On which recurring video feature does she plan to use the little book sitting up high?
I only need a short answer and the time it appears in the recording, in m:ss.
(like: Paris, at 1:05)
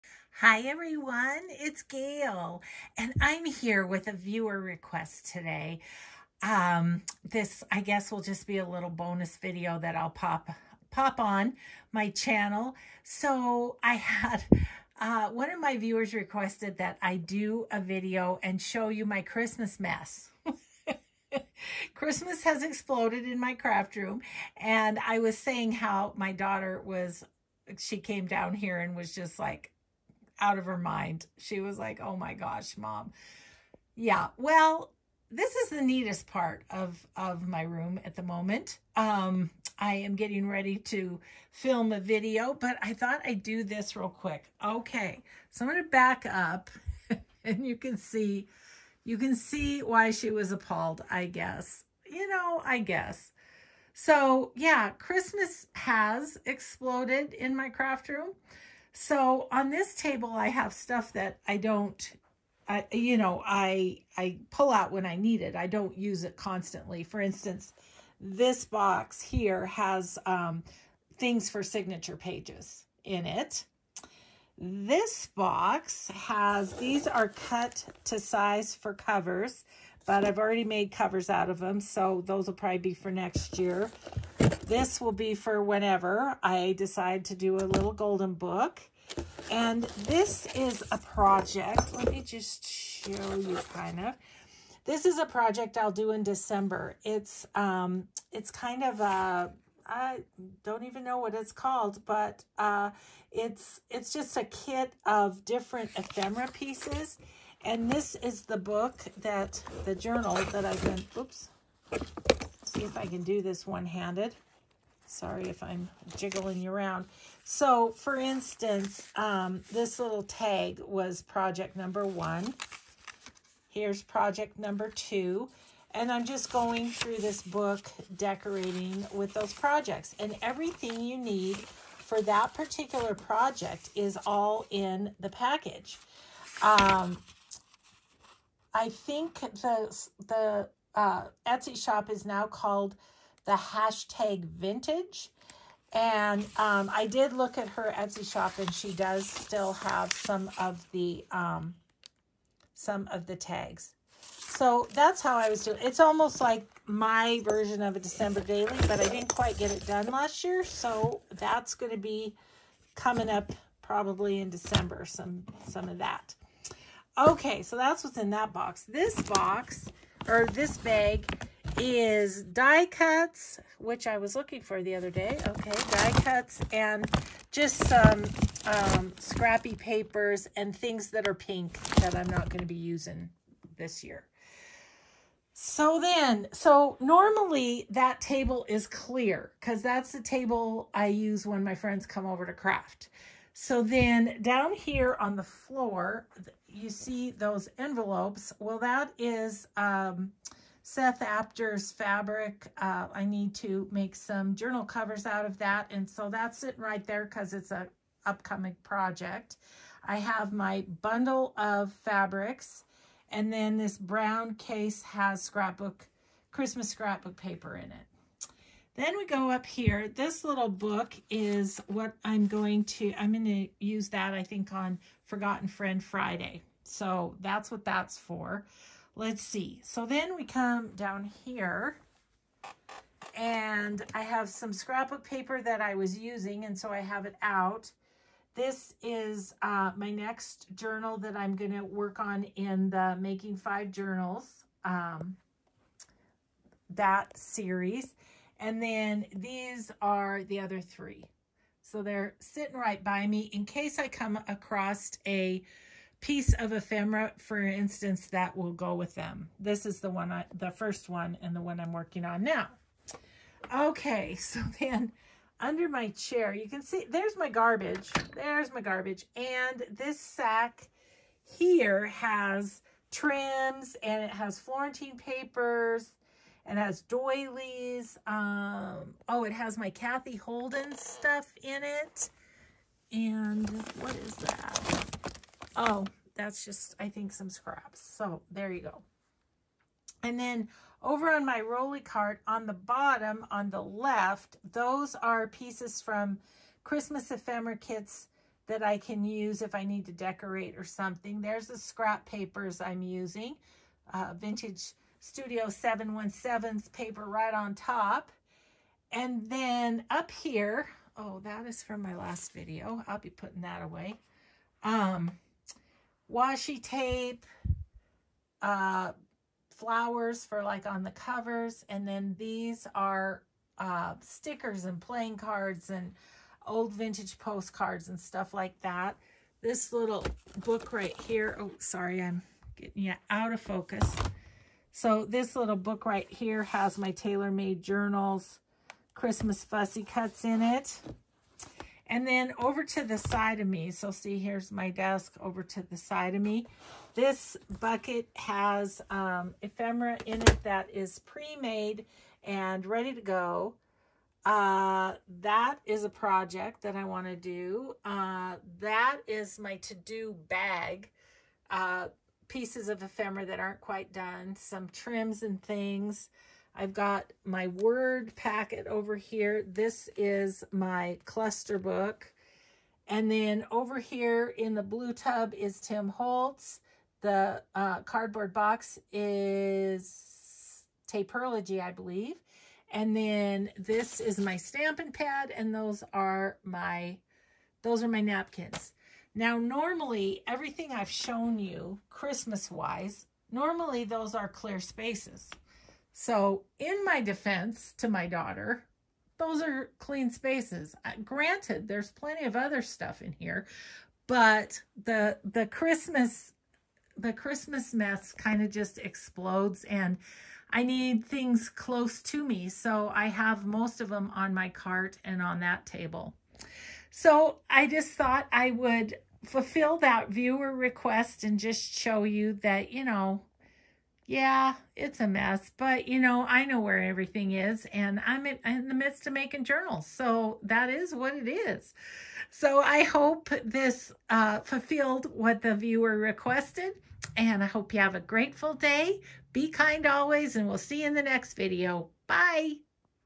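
Forgotten Friend Friday, at 3:45.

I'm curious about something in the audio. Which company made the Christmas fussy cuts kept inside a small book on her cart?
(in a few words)
Tailor-Made Journals.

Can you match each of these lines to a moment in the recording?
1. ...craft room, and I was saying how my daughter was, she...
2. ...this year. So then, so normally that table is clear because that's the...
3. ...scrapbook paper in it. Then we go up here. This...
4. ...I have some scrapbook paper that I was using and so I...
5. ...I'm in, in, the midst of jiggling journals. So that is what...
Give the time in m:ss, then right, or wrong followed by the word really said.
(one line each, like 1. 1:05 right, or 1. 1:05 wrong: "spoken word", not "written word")
1. 0:23 right
2. 3:03 right
3. 3:36 right
4. 3:54 right
5. 7:08 wrong: "making", not "jiggling".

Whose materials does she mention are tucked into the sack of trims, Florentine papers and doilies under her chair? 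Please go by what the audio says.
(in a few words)
Cathe Holden.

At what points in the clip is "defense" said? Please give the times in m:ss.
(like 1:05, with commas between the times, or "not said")
6:37.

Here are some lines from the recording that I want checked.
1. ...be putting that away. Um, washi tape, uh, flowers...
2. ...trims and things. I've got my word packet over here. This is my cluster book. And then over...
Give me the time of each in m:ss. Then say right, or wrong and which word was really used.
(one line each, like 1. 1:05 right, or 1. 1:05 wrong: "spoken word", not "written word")
1. 5:13 right
2. 6:04 right.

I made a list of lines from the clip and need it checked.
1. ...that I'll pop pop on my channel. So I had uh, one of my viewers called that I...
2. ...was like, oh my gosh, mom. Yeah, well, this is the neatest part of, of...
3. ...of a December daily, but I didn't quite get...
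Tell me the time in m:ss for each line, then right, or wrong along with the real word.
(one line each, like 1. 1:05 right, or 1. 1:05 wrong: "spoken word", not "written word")
1. 0:09 wrong: "requested", not "called"
2. 0:31 right
3. 2:37 right.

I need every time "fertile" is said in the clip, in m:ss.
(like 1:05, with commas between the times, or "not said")
not said.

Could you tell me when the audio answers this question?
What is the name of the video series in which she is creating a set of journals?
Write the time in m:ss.
4:03.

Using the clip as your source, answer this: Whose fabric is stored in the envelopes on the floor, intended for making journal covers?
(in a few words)
Seth Apter.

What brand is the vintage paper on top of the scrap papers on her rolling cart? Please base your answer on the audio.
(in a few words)
Studio 717.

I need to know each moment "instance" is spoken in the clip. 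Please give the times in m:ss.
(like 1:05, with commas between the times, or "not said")
1:07, 1:58, 4:17.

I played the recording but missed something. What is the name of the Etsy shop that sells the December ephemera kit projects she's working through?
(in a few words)
the hashtag vintage.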